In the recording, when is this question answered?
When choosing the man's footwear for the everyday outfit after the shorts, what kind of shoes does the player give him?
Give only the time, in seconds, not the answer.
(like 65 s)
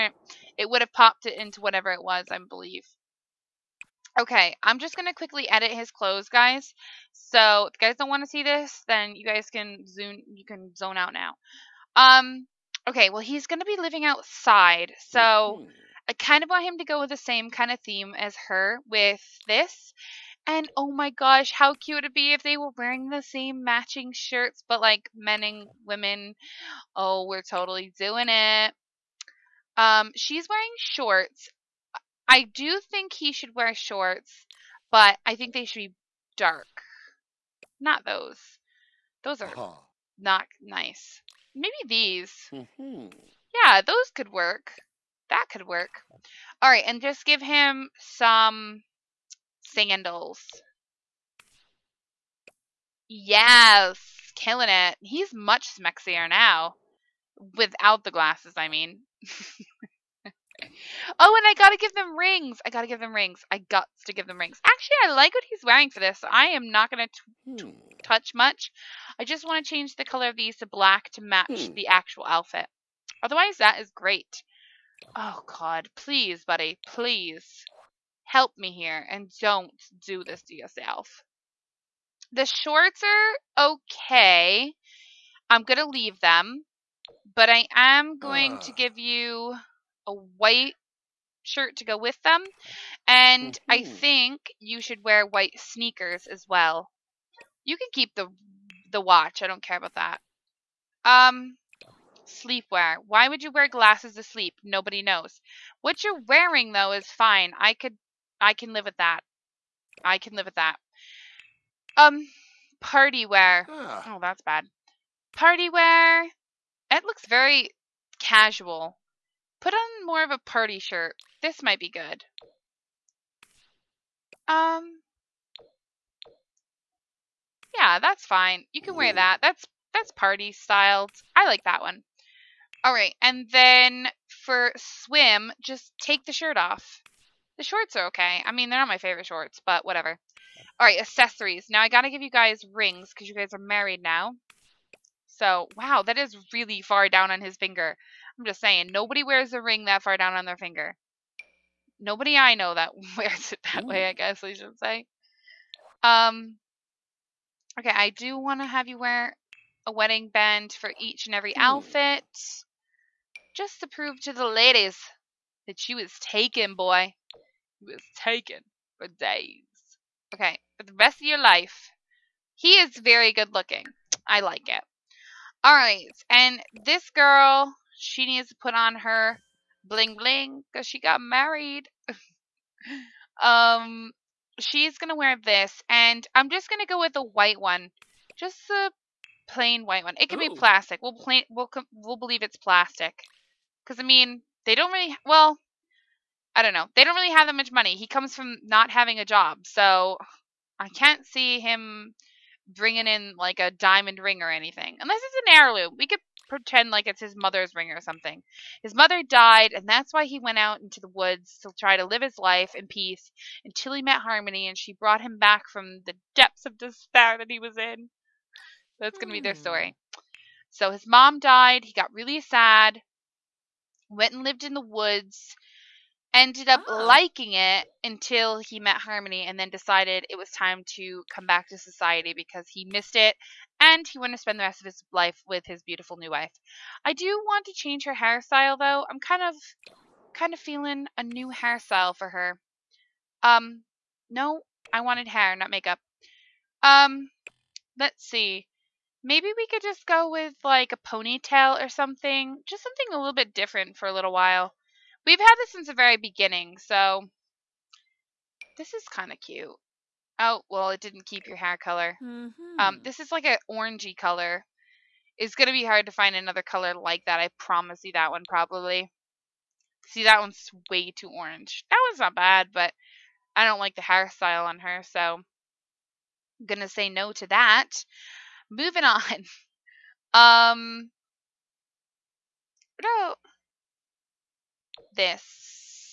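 49 s.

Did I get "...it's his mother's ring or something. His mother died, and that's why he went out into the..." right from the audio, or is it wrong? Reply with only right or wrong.
right.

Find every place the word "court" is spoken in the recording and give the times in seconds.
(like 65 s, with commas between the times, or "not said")
not said.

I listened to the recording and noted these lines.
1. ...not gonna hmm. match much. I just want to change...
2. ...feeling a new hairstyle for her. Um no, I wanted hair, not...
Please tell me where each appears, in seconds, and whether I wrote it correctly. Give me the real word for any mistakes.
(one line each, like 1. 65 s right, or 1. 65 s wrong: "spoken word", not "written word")
1. 66 s wrong: "touch", not "match"
2. 240 s right.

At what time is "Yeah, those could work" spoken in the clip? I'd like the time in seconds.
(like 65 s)
43 s.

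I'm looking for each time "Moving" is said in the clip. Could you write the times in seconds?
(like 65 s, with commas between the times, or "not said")
278 s.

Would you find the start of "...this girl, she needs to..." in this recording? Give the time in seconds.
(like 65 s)
176 s.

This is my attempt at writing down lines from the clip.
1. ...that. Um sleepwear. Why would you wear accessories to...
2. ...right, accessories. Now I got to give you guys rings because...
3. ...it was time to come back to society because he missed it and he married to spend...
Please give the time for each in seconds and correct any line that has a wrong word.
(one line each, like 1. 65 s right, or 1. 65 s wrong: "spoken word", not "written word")
1. 99 s wrong: "glasses", not "accessories"
2. 140 s right
3. 230 s wrong: "wanted", not "married".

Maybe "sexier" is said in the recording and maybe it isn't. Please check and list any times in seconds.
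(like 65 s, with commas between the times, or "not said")
55 s.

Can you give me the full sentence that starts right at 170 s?
Okay, for the rest of your life.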